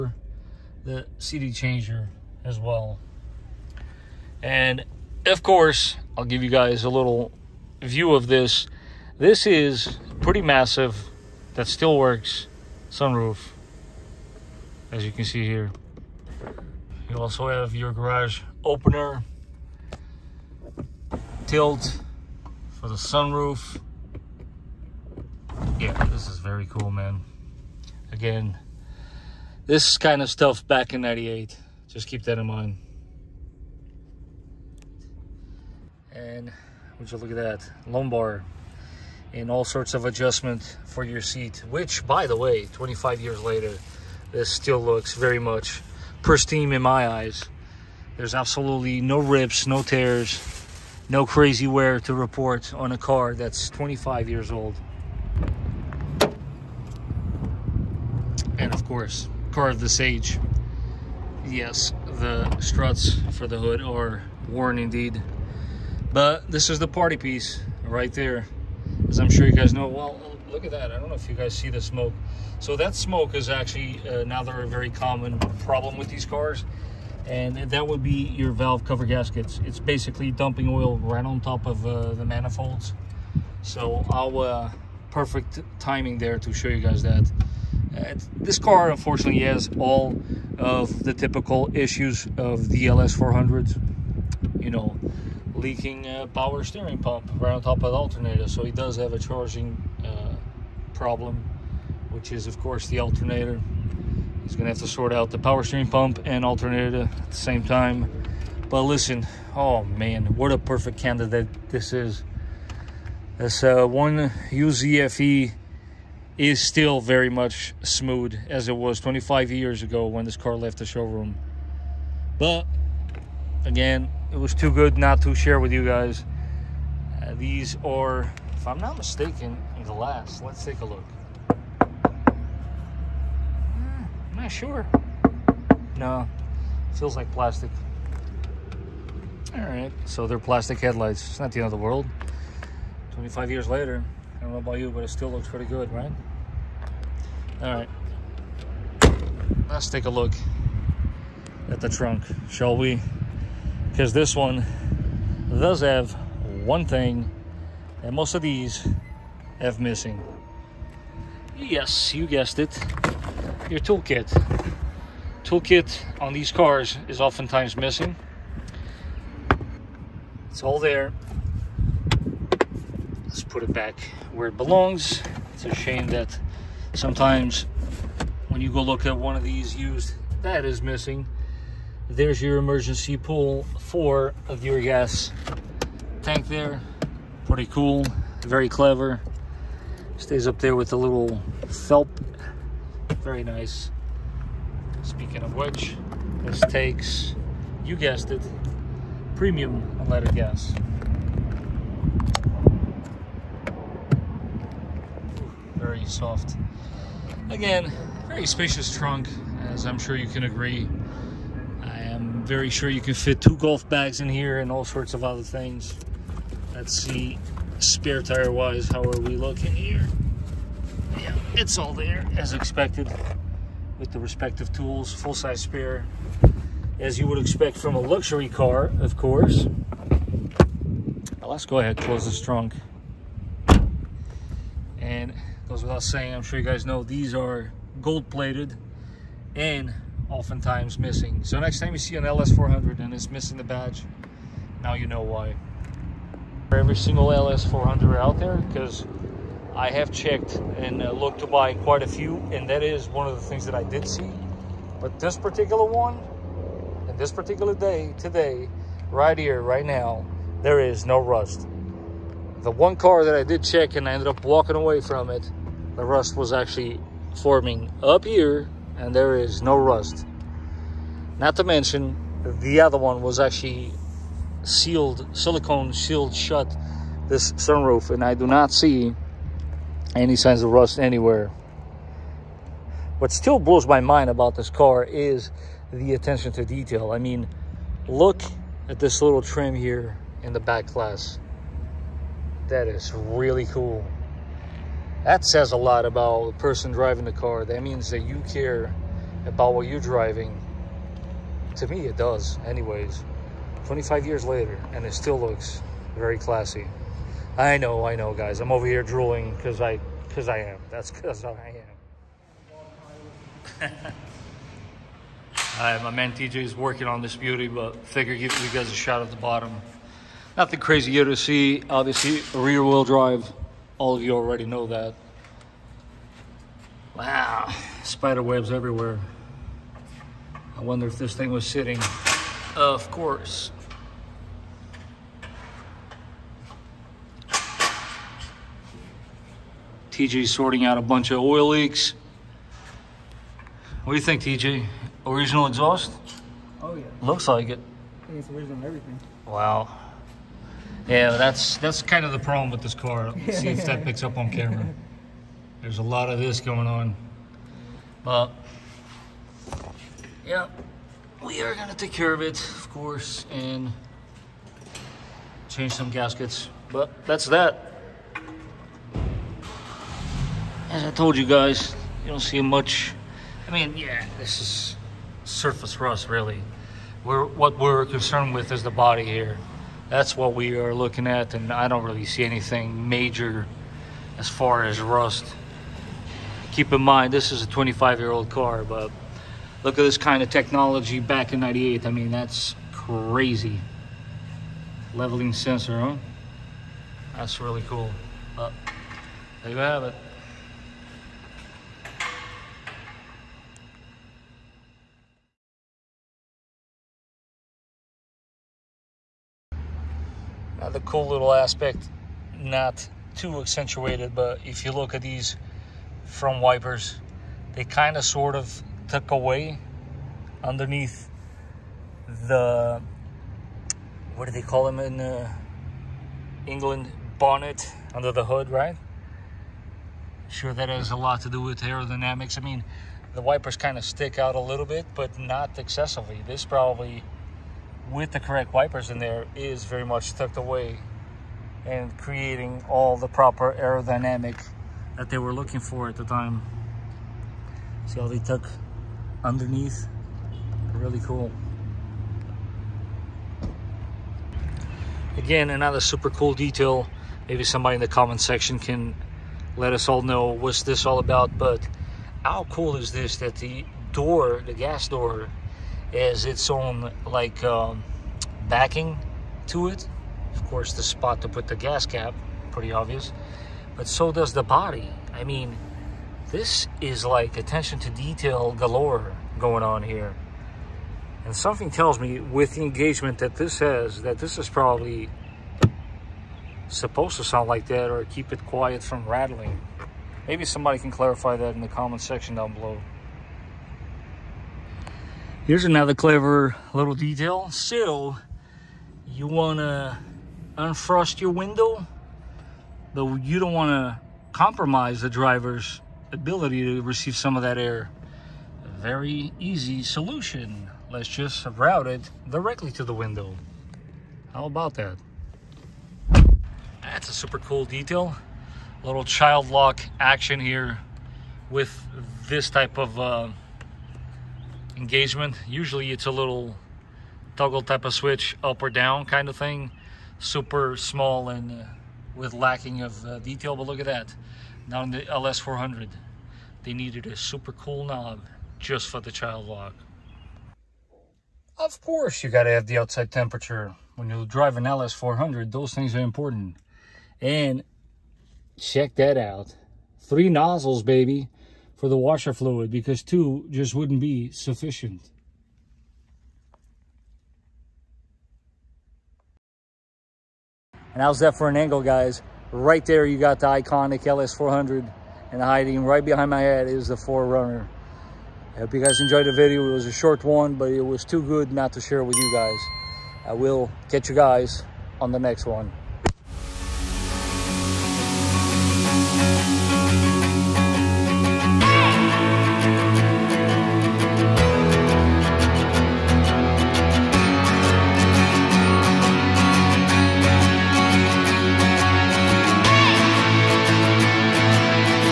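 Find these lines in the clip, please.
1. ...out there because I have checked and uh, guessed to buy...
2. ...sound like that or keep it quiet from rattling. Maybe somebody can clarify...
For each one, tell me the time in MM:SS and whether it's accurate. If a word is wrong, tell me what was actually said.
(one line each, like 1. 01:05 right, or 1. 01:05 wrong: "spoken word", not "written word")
1. 04:08 wrong: "looked", not "guessed"
2. 08:07 right.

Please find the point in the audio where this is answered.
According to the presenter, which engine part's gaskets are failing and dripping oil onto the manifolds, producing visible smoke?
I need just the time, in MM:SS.
01:18.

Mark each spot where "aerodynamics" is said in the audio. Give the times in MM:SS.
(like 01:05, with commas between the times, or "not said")
07:11, 07:23.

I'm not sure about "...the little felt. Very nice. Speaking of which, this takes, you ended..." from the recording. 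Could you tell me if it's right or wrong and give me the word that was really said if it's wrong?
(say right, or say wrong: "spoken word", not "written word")
wrong: "guessed", not "ended".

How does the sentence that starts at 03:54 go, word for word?
And goes without saying, I'm sure you guys know, these are gold-plated and oftentimes missing.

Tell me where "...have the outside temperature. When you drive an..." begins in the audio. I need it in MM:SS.
09:02.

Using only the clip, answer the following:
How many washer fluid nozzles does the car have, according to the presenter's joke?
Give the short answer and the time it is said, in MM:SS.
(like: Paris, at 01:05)
3, at 09:10.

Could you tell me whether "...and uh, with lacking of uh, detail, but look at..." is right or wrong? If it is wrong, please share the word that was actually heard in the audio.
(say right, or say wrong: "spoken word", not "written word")
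right.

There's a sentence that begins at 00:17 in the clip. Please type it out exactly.
You also have your garage opener, tilt for the sunroof.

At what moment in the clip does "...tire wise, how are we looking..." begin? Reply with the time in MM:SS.
03:38.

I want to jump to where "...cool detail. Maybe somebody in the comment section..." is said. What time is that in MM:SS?
07:36.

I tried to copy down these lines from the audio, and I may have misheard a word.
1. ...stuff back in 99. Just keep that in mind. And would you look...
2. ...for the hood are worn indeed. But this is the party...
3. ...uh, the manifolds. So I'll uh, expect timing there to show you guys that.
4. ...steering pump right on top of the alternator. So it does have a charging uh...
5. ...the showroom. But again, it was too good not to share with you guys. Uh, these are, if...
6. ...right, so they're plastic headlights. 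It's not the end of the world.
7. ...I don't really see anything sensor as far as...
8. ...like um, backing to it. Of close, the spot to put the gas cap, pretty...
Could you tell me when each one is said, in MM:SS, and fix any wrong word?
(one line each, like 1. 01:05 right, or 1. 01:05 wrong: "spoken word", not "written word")
1. 00:30 wrong: "98", not "99"
2. 01:03 right
3. 01:21 wrong: "perfect", not "expect"
4. 01:36 right
5. 02:00 right
6. 02:19 right
7. 06:21 wrong: "major", not "sensor"
8. 07:47 wrong: "course", not "close".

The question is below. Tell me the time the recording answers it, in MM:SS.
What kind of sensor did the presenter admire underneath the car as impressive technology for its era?
06:35.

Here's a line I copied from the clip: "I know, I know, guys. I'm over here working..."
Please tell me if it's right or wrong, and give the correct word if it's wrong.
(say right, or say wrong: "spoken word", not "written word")
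wrong: "drooling", not "working".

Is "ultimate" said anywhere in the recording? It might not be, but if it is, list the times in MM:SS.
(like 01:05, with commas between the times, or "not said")
not said.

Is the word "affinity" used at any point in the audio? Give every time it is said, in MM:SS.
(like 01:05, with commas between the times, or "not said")
not said.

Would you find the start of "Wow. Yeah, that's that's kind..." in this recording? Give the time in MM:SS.
05:49.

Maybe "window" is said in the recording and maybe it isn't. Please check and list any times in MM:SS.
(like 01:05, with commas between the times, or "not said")
08:21, 08:33.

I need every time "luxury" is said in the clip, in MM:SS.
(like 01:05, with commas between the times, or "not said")
03:47.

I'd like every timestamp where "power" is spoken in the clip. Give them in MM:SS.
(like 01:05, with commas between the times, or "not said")
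01:36, 01:45.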